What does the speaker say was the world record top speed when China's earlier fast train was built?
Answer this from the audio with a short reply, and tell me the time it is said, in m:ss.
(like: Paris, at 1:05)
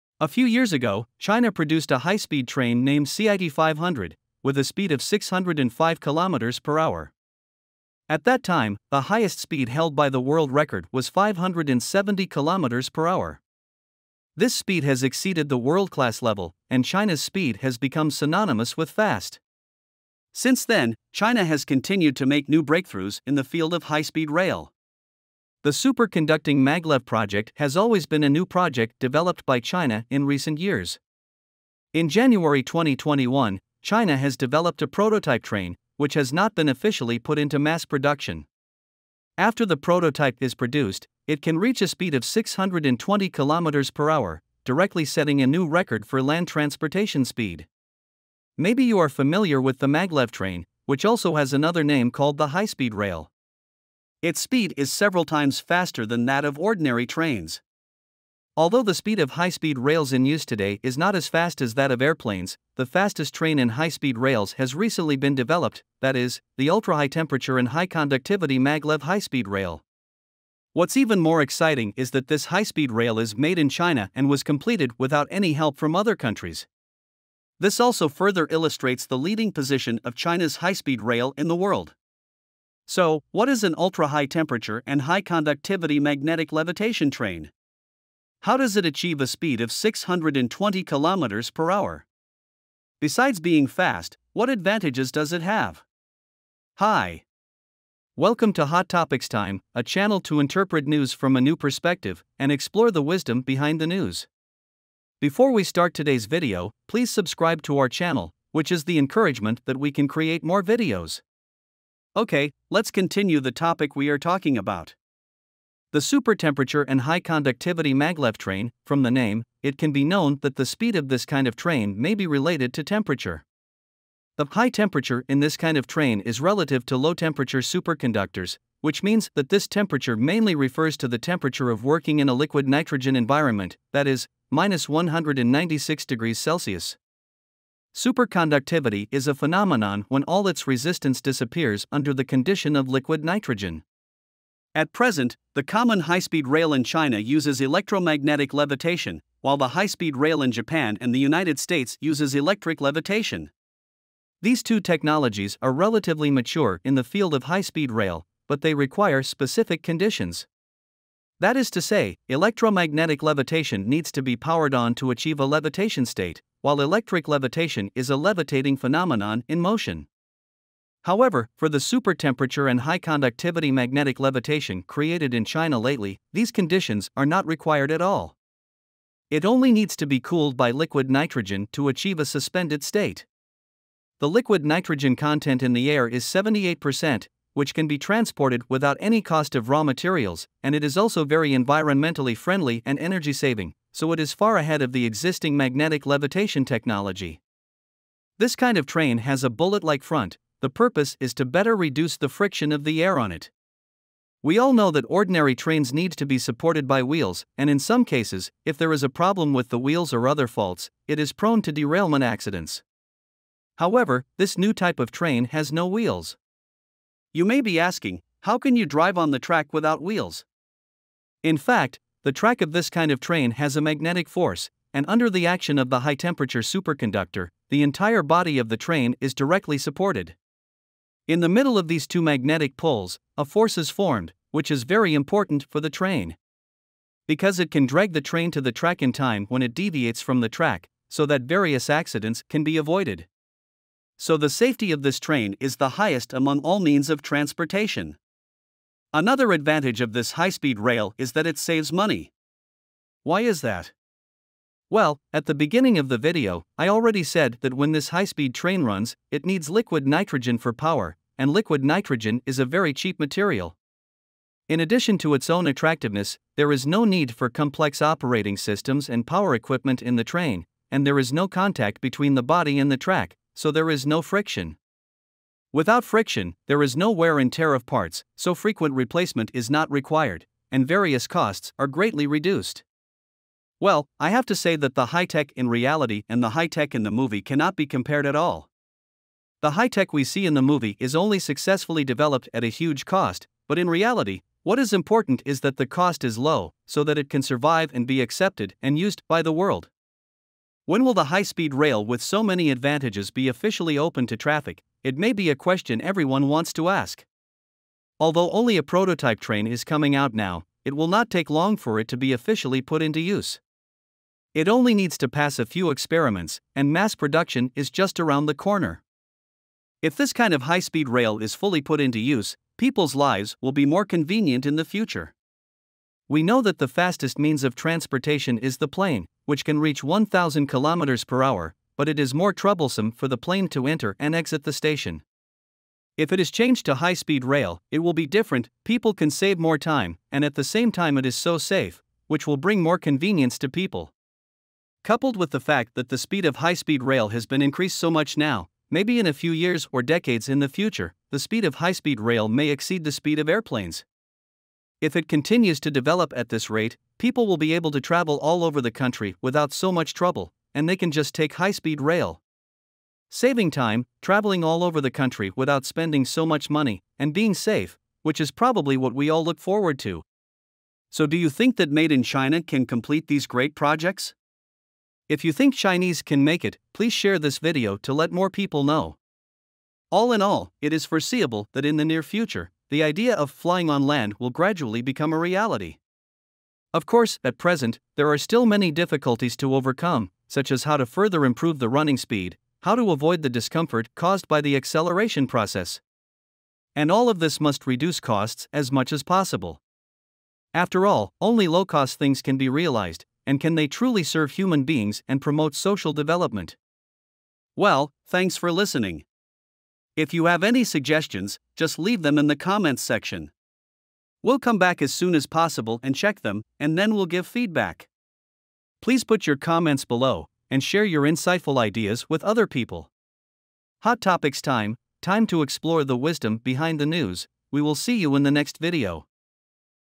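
570 km per hour, at 0:11.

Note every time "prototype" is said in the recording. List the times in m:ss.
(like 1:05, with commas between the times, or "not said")
0:34, 0:39, 5:08.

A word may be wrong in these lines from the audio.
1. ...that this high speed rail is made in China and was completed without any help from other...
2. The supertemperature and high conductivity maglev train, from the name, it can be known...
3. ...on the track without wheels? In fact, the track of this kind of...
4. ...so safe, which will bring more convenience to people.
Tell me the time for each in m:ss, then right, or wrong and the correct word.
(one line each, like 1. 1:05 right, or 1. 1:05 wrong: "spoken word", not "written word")
1. 1:12 right
2. 1:55 right
3. 3:39 right
4. 5:41 right.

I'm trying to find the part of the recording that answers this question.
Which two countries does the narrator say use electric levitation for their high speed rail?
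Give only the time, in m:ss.
2:30.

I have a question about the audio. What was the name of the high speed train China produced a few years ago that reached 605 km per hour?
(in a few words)
CIT 500.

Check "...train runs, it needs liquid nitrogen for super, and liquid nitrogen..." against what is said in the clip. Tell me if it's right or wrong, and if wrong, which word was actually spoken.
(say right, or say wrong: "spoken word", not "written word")
wrong: "power", not "super".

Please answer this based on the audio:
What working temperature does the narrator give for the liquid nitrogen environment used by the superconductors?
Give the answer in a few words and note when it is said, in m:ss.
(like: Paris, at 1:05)
-196 degrees Celsius, at 2:14.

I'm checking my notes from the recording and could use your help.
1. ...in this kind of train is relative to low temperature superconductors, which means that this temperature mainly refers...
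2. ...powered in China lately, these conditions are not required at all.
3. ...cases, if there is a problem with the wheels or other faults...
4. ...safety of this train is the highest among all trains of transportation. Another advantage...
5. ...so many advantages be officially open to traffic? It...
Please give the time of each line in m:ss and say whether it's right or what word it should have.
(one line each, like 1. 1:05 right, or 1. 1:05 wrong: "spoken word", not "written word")
1. 2:05 right
2. 2:54 wrong: "created", not "powered"
3. 3:28 right
4. 4:04 wrong: "means", not "trains"
5. 5:02 right.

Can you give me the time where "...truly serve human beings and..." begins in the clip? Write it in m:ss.
6:43.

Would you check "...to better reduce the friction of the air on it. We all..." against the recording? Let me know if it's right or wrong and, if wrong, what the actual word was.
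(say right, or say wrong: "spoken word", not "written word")
right.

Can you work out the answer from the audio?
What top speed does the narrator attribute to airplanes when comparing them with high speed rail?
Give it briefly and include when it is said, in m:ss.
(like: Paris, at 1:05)
1,000 km per hour, at 5:30.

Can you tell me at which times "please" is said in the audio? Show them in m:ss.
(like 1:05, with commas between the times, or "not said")
1:46, 6:16, 6:59.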